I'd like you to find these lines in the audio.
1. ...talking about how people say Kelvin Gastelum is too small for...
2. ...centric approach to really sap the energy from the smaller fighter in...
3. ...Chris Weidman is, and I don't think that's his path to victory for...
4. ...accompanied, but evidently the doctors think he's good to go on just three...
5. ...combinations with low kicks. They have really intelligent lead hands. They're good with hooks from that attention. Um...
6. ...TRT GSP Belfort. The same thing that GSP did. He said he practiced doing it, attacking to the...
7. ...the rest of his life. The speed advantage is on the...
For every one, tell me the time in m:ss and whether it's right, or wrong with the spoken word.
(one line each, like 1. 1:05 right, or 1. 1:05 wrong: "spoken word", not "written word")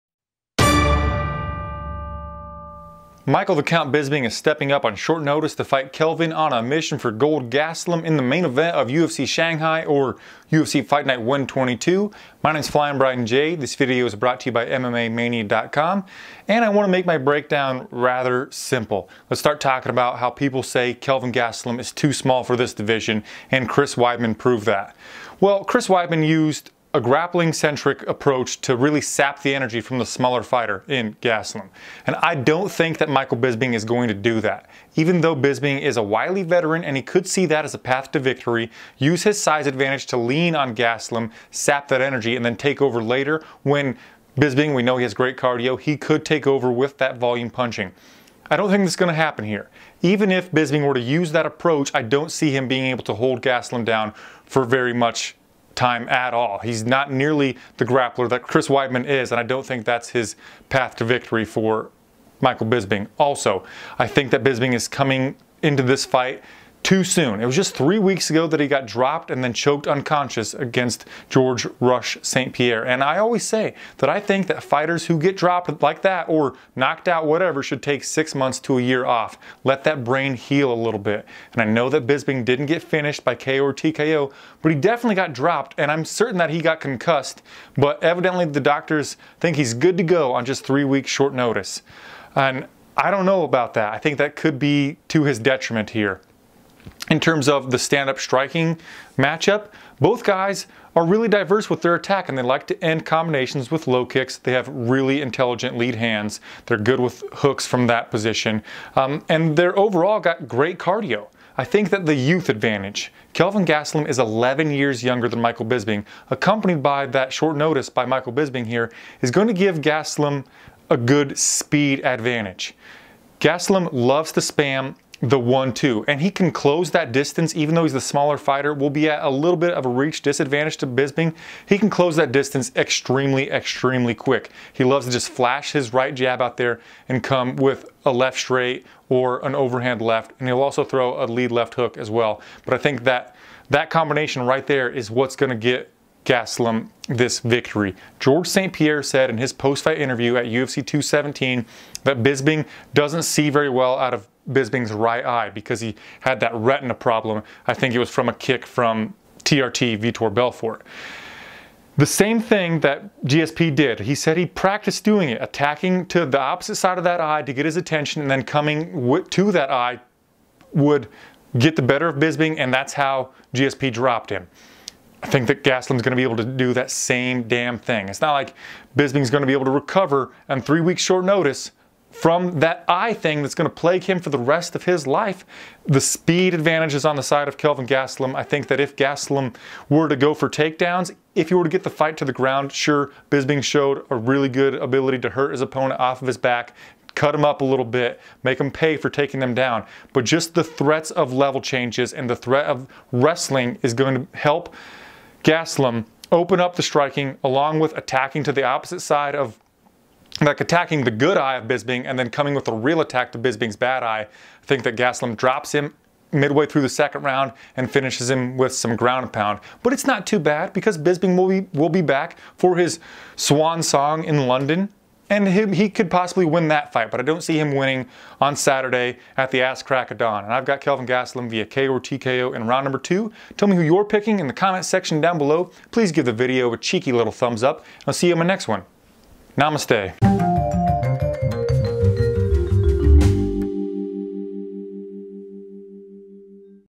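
1. 0:19 right
2. 0:27 right
3. 0:58 right
4. 1:26 wrong: "concussed", not "accompanied"
5. 1:43 wrong: "position", not "attention"
6. 2:39 wrong: "Vitor", not "GSP"
7. 3:04 right.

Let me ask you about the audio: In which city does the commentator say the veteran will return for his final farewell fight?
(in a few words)
London.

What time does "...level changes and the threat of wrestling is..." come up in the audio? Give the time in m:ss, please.
3:21.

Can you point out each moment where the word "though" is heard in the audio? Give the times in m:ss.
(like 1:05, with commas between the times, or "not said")
0:35, 2:07.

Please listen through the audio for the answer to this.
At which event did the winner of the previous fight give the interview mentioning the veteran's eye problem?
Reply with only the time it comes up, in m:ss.
2:30.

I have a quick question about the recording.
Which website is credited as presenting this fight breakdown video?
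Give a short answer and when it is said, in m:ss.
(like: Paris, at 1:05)
MMAmania.com, at 0:14.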